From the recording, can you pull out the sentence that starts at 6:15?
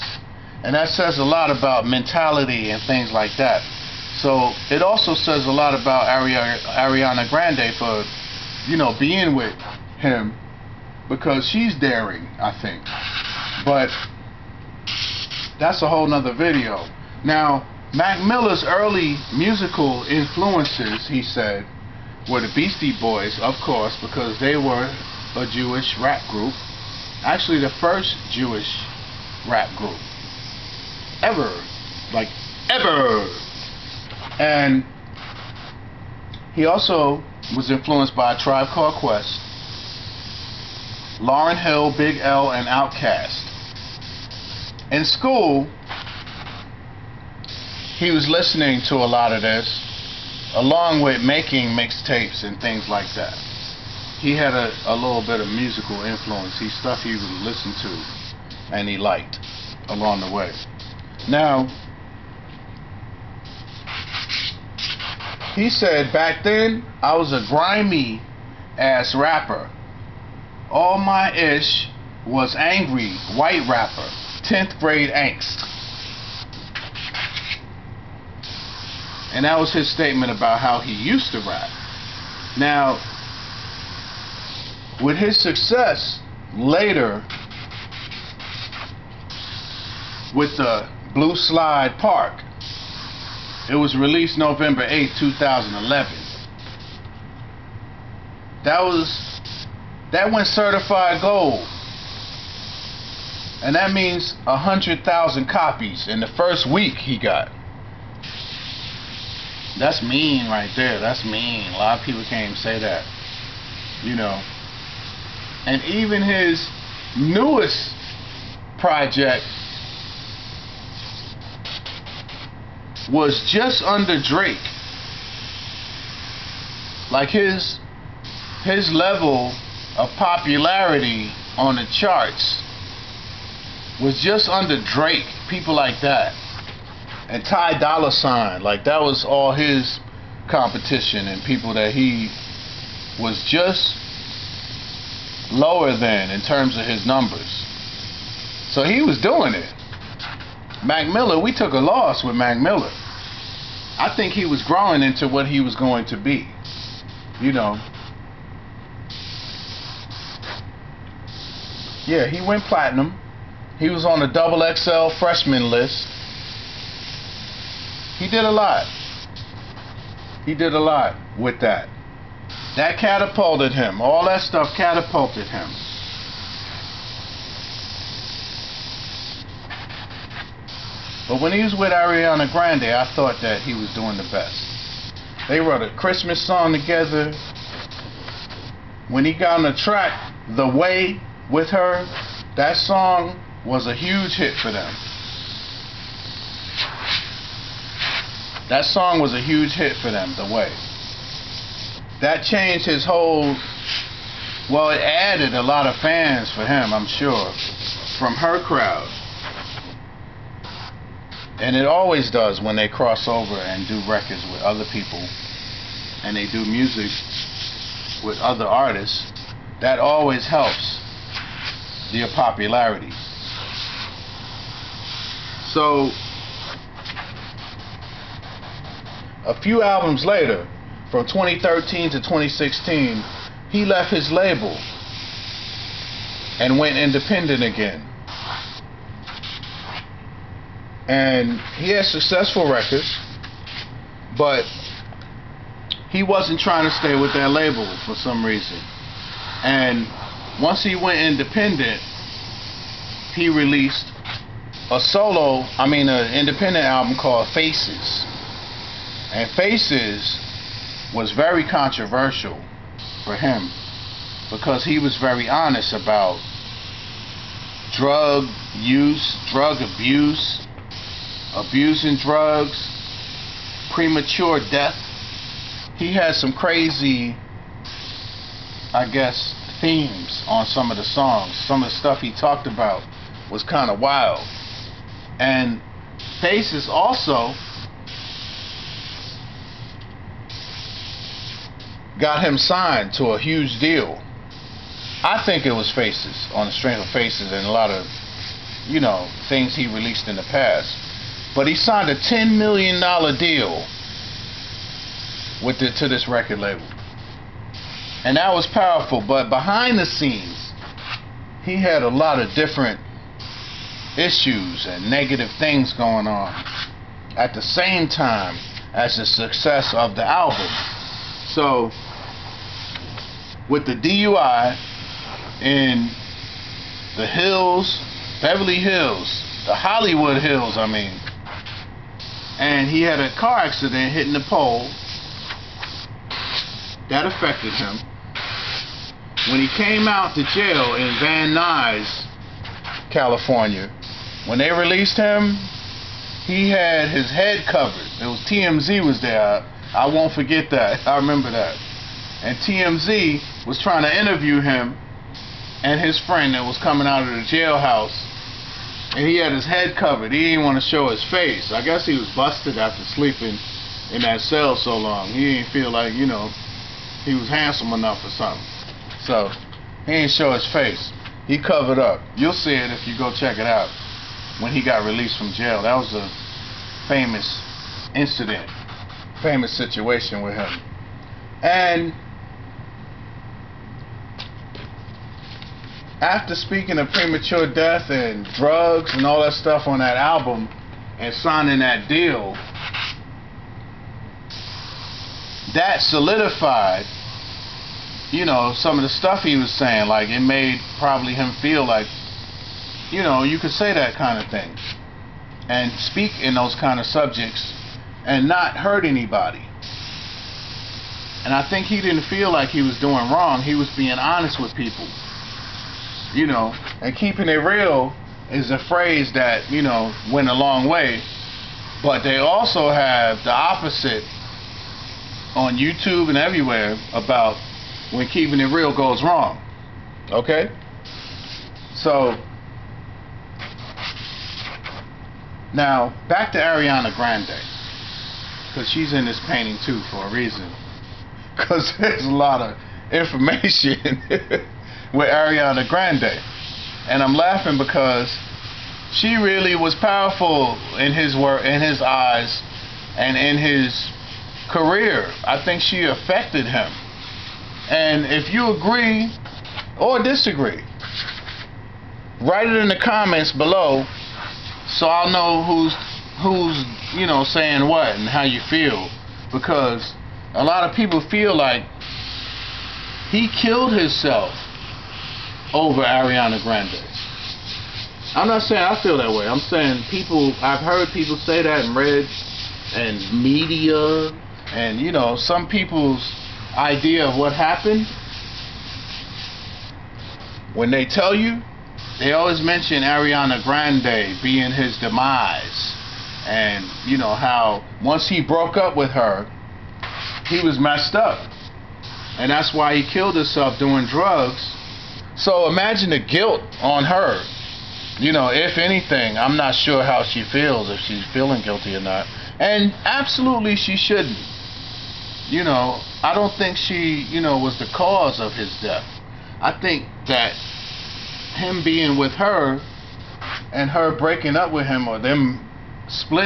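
That was a famous incident, famous situation with him.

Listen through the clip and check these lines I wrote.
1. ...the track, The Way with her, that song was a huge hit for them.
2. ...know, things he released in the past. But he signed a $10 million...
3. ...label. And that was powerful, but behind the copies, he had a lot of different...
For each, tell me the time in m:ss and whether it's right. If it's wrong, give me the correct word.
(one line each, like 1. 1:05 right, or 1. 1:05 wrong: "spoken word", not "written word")
1. 3:09 right
2. 4:58 right
3. 5:06 wrong: "scenes", not "copies".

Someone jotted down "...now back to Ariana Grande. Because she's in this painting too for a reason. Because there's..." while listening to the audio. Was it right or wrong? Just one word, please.
right.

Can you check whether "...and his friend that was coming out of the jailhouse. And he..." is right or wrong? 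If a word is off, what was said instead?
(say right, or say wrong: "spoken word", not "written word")
right.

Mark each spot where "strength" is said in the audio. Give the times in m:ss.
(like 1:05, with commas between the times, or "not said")
4:56.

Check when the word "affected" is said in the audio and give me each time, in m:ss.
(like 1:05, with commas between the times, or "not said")
5:37, 7:36.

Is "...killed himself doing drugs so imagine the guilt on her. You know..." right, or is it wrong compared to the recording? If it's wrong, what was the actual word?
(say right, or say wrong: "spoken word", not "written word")
right.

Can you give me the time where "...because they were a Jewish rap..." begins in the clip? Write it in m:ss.
0:24.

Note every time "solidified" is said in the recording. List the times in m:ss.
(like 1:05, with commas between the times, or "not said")
6:35.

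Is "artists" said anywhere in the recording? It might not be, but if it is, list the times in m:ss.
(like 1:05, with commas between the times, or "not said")
3:38.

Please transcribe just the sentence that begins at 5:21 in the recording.
So with the DUI in the hills, Beverly Hills, the Hollywood Hills, I mean.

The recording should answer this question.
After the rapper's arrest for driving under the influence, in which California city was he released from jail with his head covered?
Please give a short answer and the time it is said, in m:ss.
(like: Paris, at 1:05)
Van Nuys, at 5:41.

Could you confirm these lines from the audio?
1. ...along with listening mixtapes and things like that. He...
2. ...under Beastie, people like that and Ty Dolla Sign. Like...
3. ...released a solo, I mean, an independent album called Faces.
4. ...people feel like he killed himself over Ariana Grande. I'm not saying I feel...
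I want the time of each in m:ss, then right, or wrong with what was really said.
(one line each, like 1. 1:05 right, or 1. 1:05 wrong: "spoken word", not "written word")
1. 0:50 wrong: "making", not "listening"
2. 2:14 wrong: "Drake", not "Beastie"
3. 4:13 right
4. 7:50 right.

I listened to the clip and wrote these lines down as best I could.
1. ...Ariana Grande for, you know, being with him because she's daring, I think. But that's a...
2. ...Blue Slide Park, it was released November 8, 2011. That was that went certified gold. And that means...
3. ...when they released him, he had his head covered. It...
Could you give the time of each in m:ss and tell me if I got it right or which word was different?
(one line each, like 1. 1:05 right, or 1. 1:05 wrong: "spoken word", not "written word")
1. 0:06 right
2. 1:31 right
3. 5:44 right.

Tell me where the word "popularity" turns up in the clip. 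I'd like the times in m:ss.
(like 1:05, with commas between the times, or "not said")
2:10, 3:42.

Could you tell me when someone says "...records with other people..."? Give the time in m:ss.
3:34.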